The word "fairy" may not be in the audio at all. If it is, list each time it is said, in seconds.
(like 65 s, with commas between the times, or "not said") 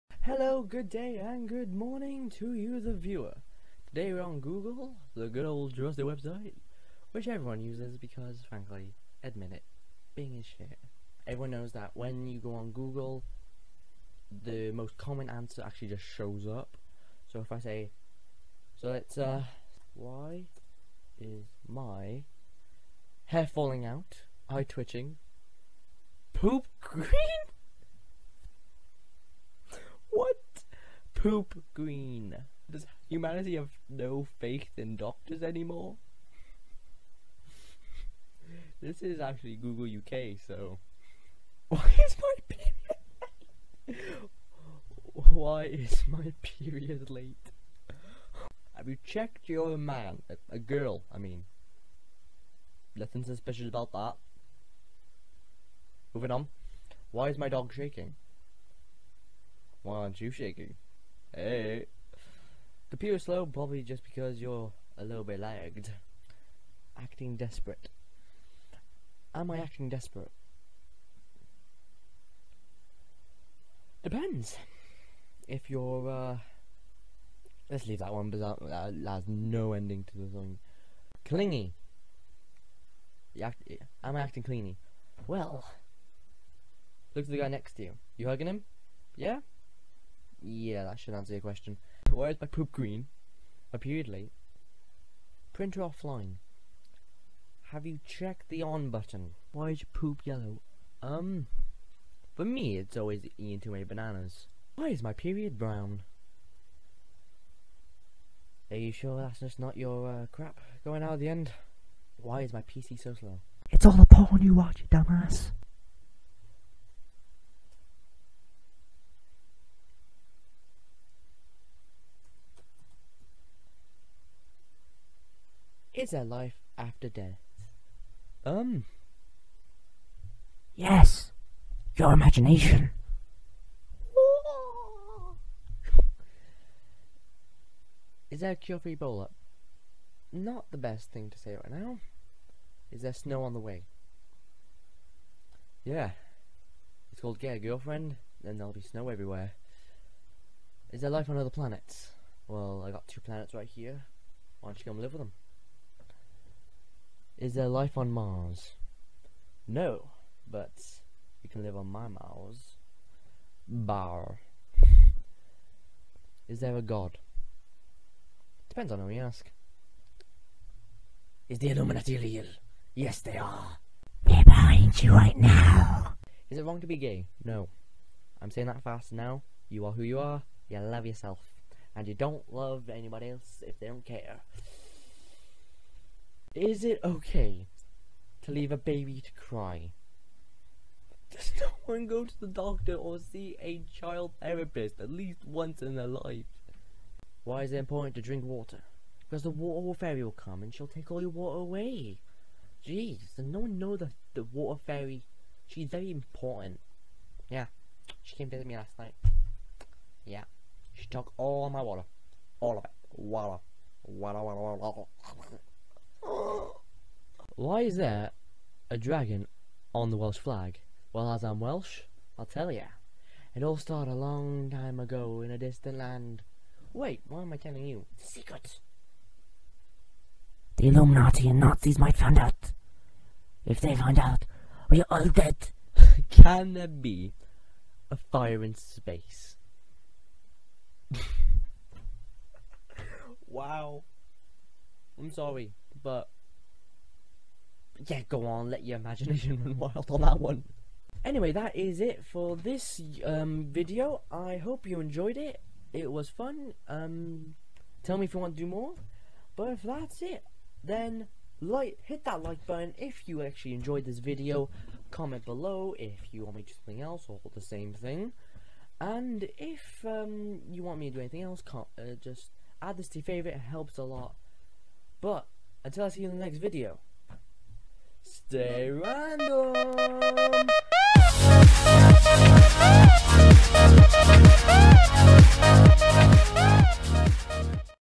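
199 s, 204 s.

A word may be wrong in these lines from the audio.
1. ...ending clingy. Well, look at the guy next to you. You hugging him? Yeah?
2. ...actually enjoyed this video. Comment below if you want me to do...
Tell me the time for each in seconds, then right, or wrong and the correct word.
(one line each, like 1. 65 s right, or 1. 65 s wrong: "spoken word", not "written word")
1. 84 s wrong: "acting", not "ending"
2. 263 s right.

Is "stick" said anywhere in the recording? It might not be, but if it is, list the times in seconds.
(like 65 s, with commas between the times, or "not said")
not said.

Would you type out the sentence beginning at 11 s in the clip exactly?
Everyone knows that when you go on Google, the most common answer actually just shows up.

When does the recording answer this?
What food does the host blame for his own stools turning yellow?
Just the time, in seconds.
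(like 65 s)
103 s.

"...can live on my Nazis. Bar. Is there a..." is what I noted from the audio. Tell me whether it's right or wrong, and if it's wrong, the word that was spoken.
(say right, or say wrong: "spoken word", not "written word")
wrong: "Mars", not "Nazis".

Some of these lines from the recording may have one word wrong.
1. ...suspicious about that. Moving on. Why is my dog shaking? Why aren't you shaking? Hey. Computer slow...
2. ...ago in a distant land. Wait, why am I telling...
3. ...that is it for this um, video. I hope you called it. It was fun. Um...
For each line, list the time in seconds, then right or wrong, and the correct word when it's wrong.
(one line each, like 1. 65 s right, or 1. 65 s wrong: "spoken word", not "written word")
1. 53 s right
2. 224 s right
3. 251 s wrong: "enjoyed", not "called".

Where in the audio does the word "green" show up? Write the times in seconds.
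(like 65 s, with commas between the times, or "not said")
26 s, 31 s, 92 s.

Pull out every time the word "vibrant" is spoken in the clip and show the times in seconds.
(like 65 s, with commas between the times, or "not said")
not said.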